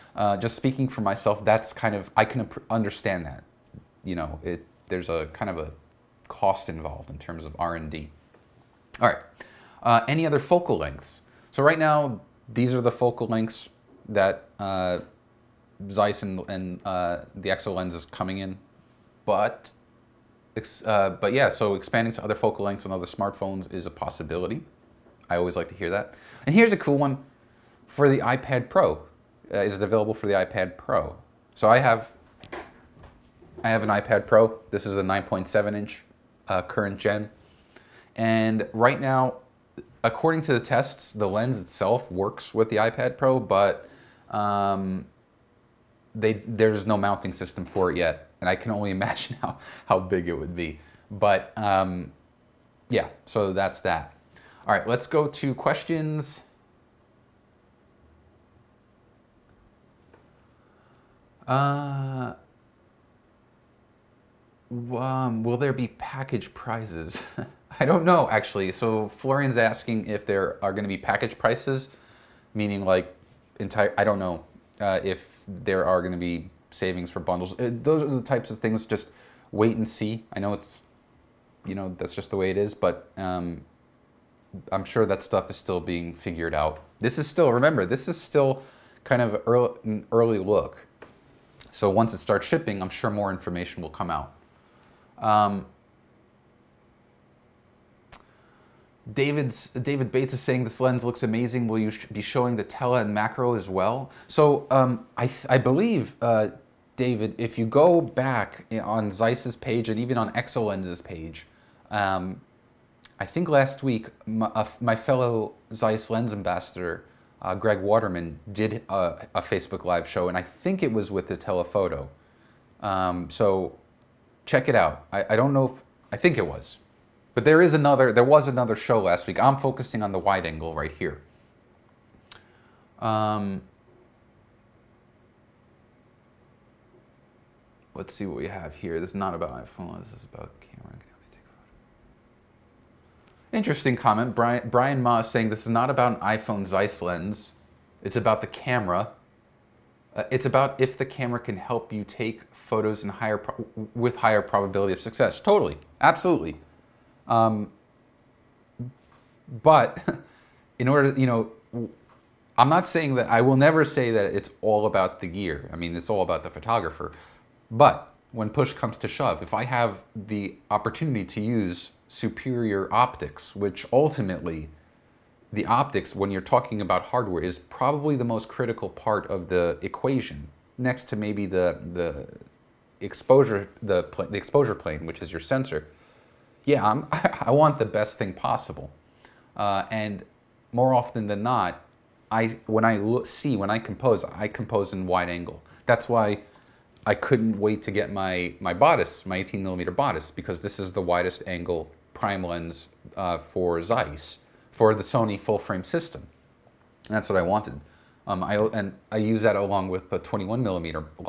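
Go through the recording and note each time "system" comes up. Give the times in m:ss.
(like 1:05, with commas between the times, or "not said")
0:47, 3:25.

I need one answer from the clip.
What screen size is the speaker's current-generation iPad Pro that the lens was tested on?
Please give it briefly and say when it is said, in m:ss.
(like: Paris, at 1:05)
9.7 inch, at 0:35.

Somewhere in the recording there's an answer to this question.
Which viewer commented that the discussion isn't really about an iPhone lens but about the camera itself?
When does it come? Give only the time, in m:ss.
2:24.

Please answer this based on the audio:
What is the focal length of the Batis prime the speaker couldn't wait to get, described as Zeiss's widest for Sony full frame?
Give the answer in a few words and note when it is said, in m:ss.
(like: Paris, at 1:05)
18 millimeter, at 3:19.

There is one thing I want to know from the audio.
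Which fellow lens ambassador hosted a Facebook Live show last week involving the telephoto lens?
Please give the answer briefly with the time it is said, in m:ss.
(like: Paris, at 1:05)
Greg Waterman, at 1:57.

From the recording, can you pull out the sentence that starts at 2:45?
I mean, it's all about the photographer.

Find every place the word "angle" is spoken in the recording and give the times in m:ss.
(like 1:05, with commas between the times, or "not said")
2:10, 3:15, 3:21.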